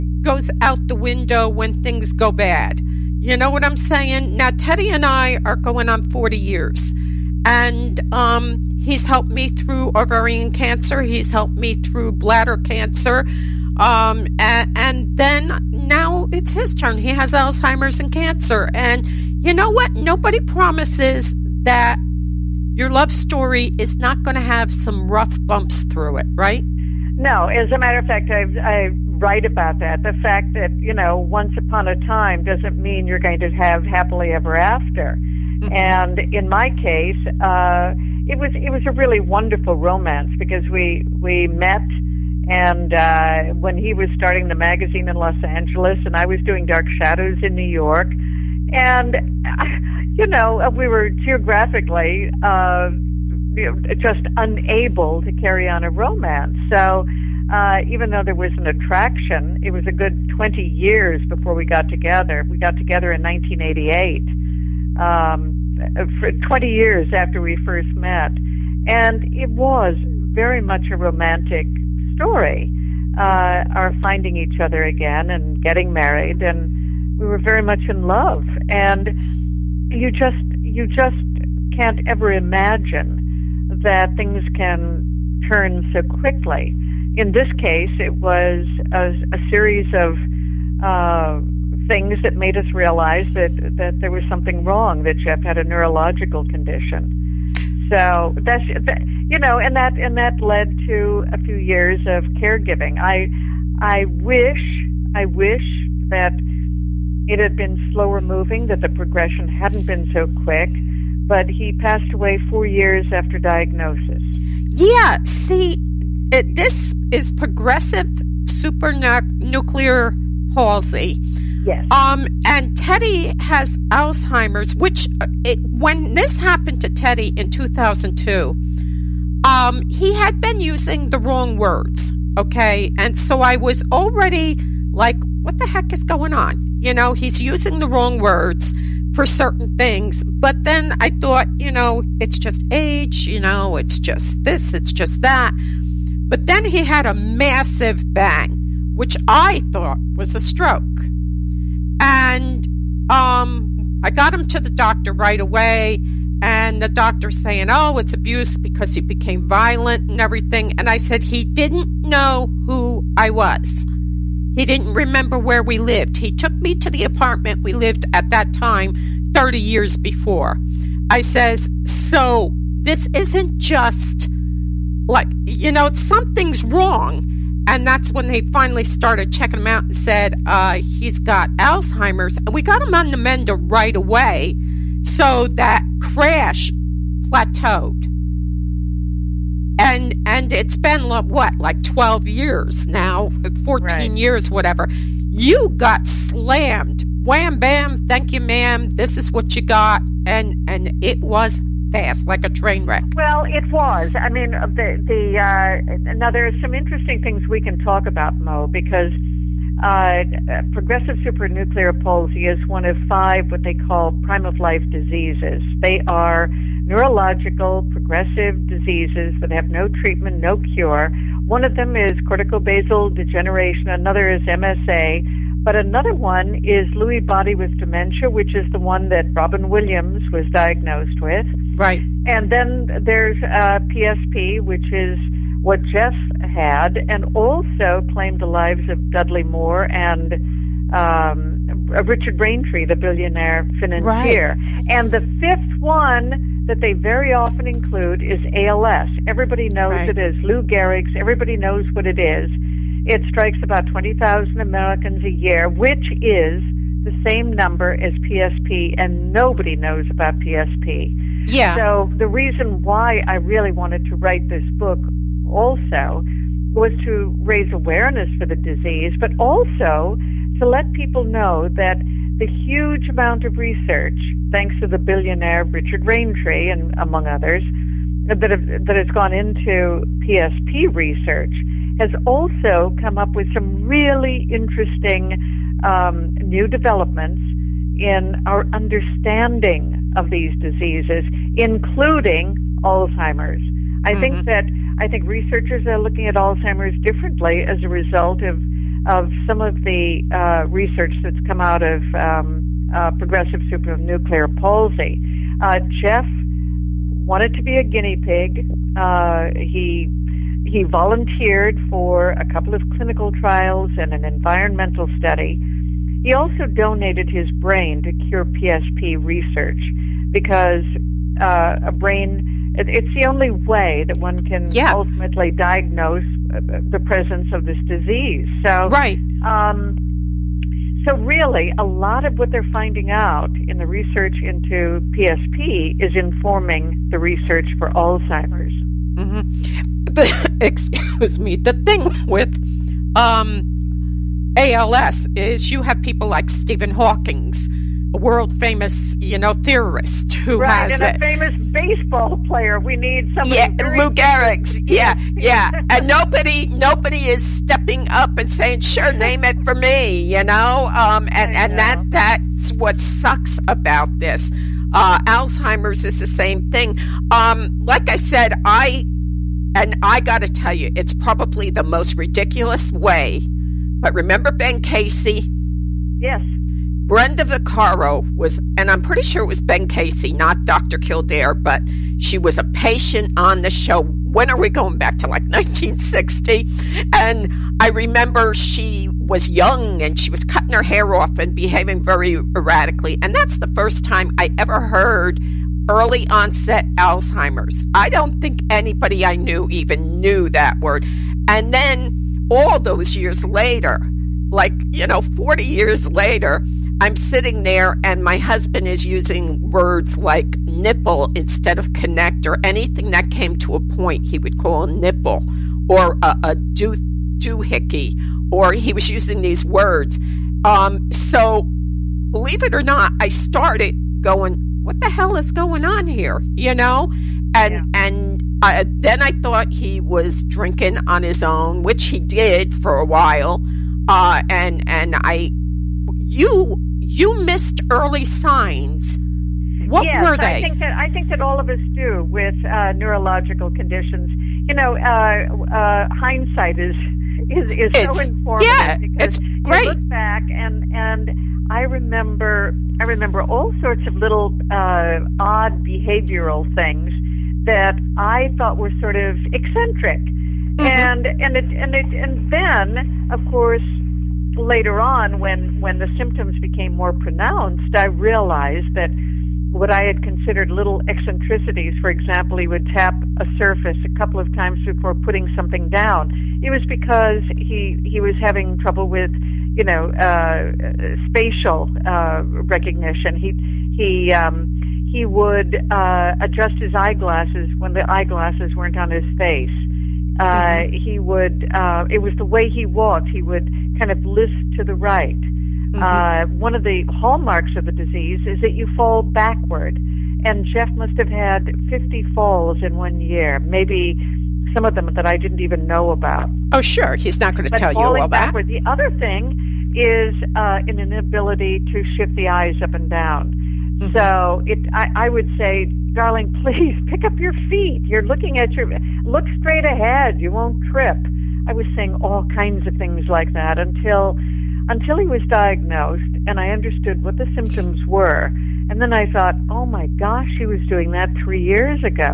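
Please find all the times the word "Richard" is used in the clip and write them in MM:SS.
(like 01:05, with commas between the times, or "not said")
04:02, 04:35.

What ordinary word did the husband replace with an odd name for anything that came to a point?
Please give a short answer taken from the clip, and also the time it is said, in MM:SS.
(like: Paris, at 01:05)
connector, at 06:51.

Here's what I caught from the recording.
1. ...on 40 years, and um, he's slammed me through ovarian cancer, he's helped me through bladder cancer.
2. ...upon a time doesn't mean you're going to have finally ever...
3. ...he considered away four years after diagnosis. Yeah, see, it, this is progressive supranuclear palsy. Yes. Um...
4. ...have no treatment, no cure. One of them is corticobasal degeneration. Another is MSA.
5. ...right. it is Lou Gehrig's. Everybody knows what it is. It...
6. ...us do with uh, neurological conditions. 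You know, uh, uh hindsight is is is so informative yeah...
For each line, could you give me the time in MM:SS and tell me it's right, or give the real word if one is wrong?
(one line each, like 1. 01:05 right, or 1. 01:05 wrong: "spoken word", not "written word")
1. 00:05 wrong: "helped", not "slammed"
2. 00:31 wrong: "happily", not "finally"
3. 01:51 wrong: "passed", not "considered"
4. 03:39 right
5. 04:09 right
6. 07:21 right.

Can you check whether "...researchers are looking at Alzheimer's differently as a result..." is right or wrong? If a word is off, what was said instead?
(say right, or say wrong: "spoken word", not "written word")
right.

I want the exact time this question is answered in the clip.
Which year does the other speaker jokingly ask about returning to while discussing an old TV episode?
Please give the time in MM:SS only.
06:25.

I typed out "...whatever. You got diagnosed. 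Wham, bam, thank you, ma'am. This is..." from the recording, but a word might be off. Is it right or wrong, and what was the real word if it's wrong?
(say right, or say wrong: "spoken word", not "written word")
wrong: "slammed", not "diagnosed".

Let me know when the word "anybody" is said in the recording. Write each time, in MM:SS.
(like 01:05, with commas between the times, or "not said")
06:38.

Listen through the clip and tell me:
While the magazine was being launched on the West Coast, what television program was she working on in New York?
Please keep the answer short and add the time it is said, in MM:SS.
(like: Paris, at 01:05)
Dark Shadows, at 00:46.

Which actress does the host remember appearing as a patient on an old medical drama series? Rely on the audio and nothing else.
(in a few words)
Brenda Vaccaro.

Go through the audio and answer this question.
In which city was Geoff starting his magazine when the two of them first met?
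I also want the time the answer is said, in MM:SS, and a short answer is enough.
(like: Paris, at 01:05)
Los Angeles, at 00:45.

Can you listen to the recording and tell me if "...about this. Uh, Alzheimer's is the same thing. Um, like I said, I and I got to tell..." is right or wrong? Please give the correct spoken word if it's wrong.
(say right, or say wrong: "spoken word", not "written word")
right.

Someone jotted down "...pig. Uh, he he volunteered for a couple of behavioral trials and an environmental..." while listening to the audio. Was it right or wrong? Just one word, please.
wrong.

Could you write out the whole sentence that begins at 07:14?
Uh, and and I, you you missed early signs.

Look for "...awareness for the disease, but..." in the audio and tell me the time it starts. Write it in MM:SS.
04:27.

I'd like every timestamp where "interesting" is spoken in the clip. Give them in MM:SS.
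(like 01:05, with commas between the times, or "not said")
03:26, 04:44.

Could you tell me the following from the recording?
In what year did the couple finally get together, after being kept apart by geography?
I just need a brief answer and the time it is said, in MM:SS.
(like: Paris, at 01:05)
1988, at 01:03.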